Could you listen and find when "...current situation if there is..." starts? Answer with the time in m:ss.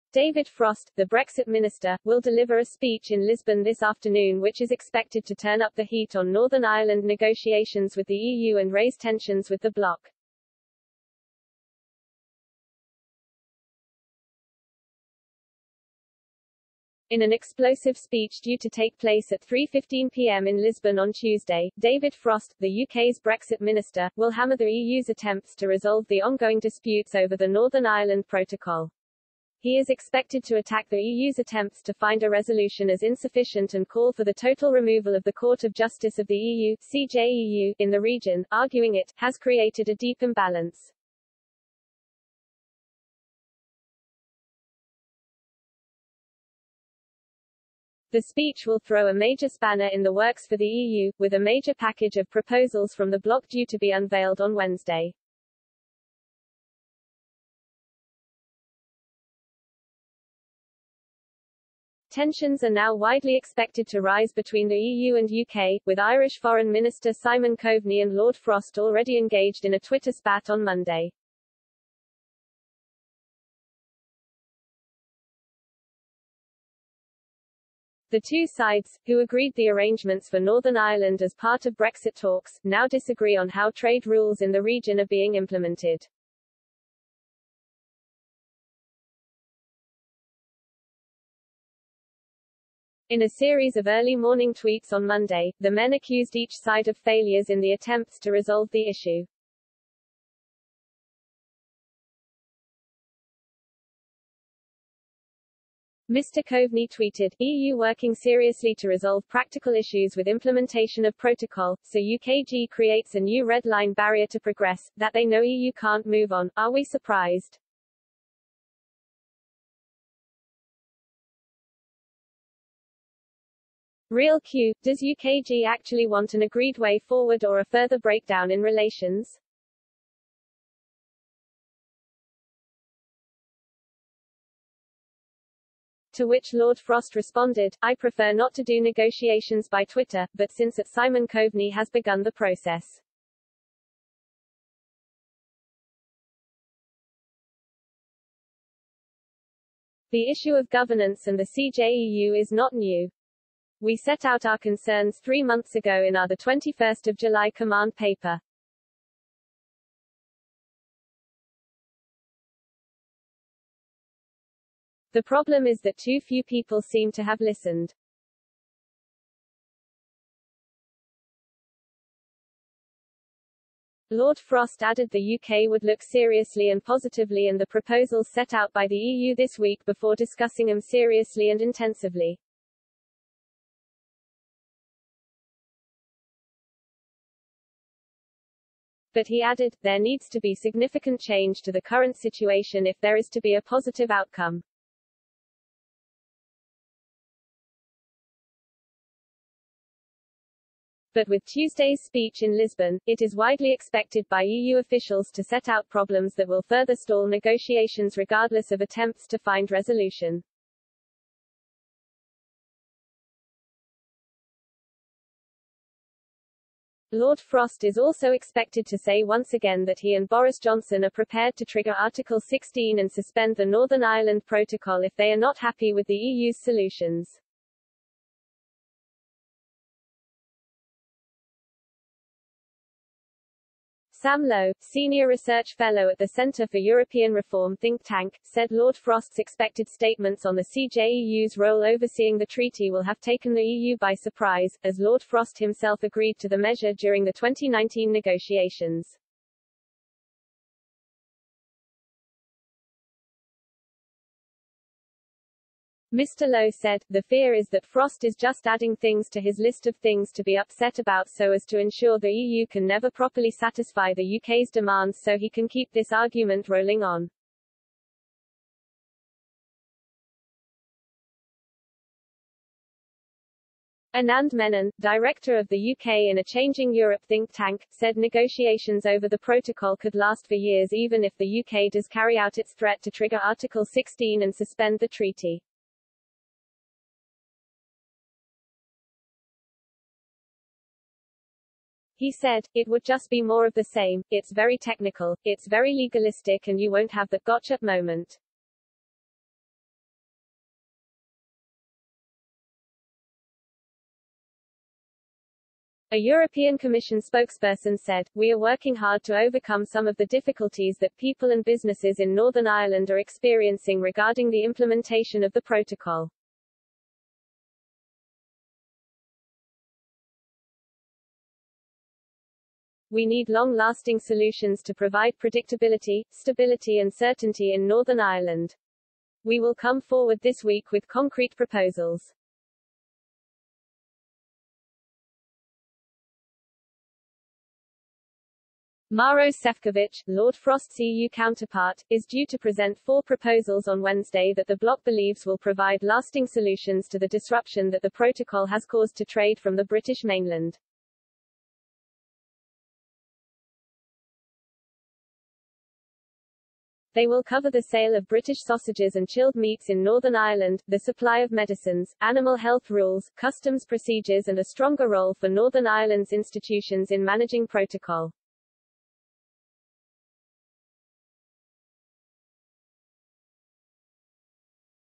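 3:11.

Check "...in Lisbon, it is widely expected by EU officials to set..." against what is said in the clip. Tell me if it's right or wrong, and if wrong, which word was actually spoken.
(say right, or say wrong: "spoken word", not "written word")
right.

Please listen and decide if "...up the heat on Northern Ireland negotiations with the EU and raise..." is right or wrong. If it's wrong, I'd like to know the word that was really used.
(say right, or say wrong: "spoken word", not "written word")
right.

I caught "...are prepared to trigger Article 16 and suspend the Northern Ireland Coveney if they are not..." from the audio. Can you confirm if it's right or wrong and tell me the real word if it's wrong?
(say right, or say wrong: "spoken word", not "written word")
wrong: "Protocol", not "Coveney".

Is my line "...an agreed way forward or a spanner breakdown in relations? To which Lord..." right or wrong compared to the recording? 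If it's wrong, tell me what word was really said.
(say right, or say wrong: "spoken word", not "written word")
wrong: "further", not "spanner".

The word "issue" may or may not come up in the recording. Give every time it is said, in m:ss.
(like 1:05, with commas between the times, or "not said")
1:38, 1:49, 2:30.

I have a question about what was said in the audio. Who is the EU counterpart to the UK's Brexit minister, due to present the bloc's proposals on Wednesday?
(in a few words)
Maros Sefcovic.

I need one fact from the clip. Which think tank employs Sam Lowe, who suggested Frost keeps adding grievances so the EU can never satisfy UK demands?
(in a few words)
Center for European Reform.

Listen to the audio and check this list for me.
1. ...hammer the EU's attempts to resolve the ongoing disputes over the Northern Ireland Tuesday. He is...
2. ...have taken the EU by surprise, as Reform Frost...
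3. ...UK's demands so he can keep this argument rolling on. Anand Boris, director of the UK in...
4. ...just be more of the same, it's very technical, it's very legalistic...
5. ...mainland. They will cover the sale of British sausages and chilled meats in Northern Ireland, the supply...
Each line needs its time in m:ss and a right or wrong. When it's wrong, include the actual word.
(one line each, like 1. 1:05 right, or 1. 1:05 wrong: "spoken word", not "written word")
1. 0:24 wrong: "Protocol", not "Tuesday"
2. 4:03 wrong: "Lord", not "Reform"
3. 4:24 wrong: "Menon", not "Boris"
4. 4:53 right
5. 5:50 right.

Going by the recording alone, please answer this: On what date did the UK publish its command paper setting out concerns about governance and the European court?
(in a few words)
21st of July.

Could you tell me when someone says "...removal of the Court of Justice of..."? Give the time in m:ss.
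0:34.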